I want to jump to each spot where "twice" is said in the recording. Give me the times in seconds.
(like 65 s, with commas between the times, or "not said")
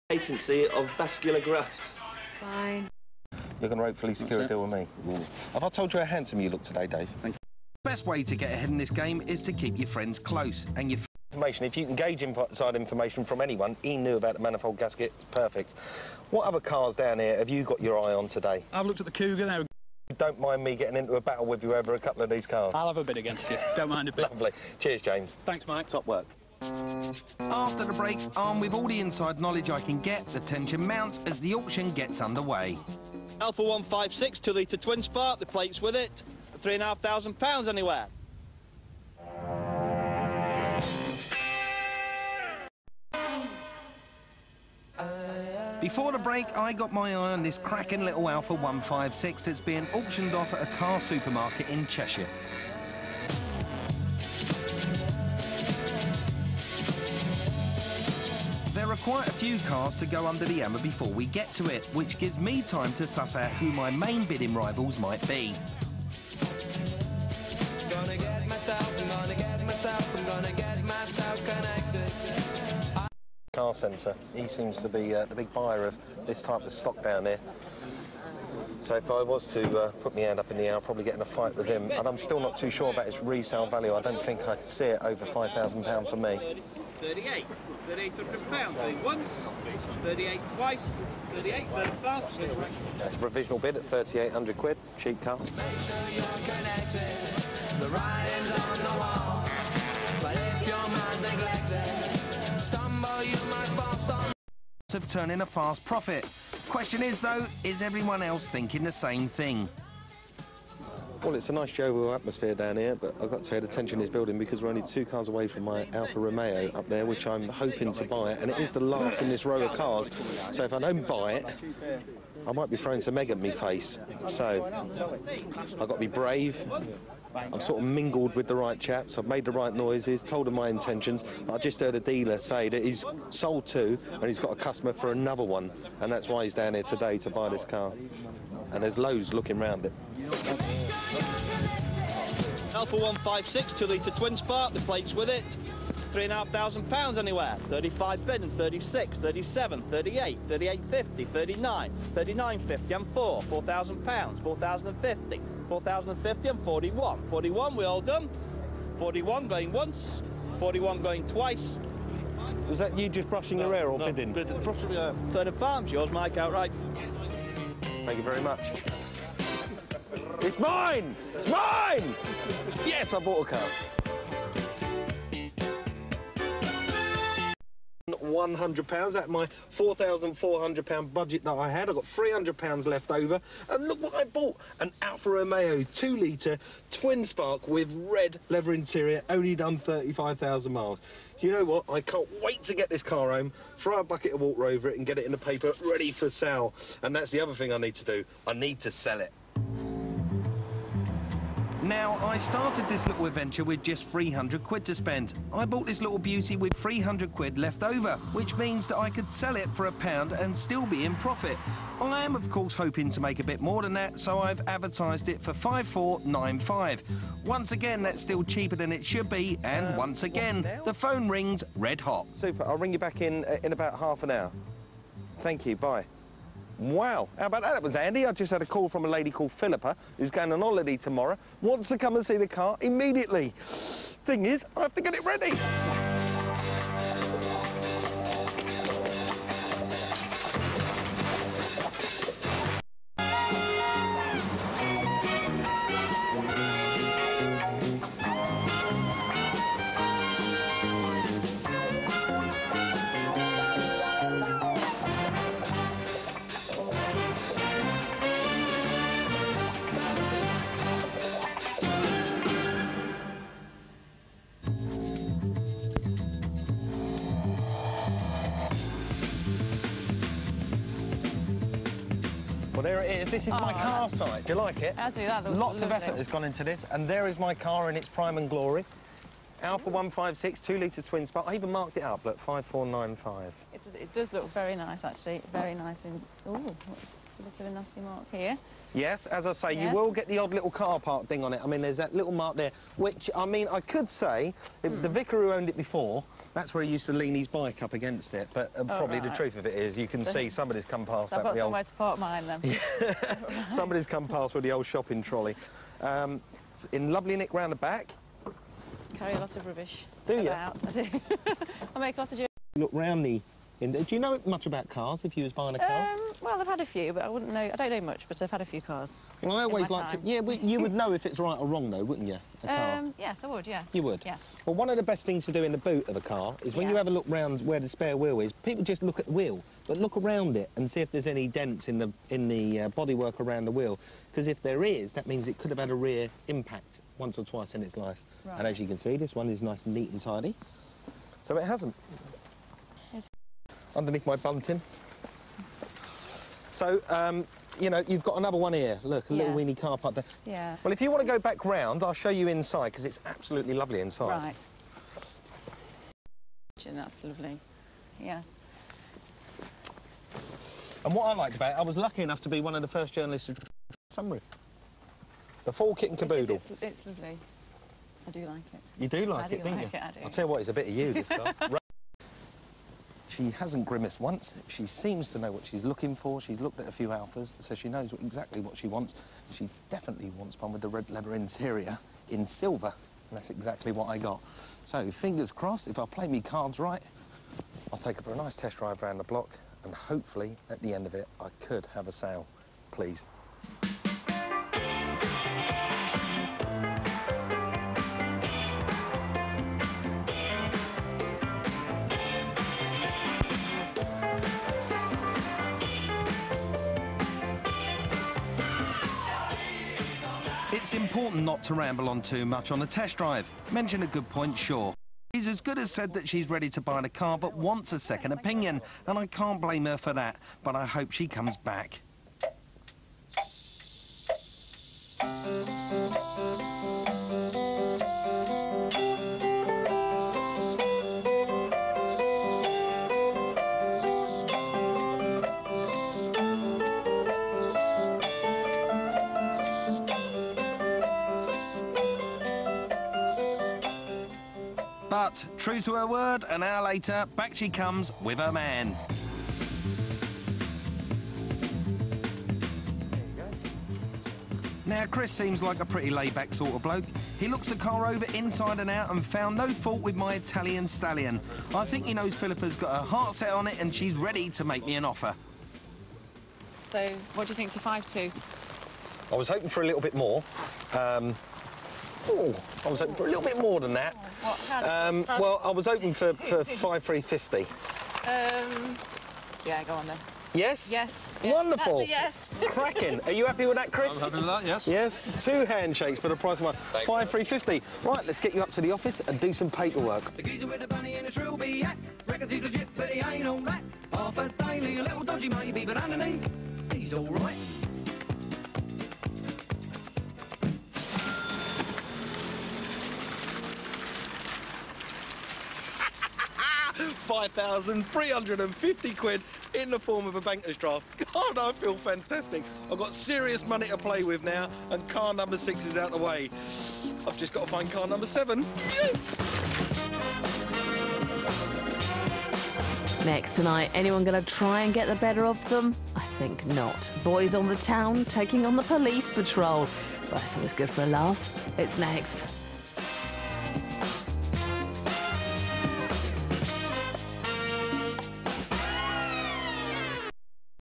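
90 s, 161 s, 337 s.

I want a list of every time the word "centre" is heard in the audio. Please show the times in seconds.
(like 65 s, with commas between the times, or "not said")
73 s.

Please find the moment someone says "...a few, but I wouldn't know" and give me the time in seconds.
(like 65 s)
316 s.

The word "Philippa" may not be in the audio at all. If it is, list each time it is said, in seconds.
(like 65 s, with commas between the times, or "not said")
229 s, 462 s.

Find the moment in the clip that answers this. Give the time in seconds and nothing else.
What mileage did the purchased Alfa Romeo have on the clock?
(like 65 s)
189 s.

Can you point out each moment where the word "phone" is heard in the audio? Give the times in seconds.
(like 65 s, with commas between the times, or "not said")
220 s.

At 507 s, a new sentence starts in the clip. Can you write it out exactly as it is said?
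5,350 quid in the form of a banker's draft.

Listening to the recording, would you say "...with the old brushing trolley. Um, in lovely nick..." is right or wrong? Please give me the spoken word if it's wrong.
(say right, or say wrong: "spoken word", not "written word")
wrong: "shopping", not "brushing".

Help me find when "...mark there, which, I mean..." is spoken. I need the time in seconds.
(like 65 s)
292 s.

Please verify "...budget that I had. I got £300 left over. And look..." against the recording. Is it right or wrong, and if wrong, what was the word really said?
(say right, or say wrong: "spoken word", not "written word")
right.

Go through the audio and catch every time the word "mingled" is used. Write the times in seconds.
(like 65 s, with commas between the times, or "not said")
127 s.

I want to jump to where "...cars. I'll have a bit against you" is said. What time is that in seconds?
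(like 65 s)
22 s.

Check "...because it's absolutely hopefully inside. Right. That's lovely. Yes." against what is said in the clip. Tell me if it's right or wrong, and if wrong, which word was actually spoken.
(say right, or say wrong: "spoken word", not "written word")
wrong: "lovely", not "hopefully".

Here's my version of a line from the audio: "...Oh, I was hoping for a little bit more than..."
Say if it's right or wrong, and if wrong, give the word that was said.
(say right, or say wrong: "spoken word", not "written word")
right.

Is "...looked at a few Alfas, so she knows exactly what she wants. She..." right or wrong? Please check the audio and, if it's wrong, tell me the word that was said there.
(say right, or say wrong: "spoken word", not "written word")
right.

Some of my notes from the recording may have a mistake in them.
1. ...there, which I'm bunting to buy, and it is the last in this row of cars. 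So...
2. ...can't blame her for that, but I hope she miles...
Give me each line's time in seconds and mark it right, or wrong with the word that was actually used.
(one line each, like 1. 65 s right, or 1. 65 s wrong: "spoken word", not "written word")
1. 116 s wrong: "hoping", not "bunting"
2. 419 s wrong: "comes", not "miles".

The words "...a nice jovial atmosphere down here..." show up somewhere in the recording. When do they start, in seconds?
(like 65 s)
111 s.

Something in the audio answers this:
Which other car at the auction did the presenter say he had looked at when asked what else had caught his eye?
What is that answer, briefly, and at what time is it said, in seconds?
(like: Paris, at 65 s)
Cougar, at 19 s.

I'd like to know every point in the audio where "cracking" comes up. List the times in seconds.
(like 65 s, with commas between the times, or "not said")
47 s, 482 s.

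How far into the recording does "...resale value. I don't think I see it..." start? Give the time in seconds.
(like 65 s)
83 s.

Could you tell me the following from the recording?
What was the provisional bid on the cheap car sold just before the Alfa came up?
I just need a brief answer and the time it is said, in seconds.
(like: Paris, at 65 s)
£3,800, at 87 s.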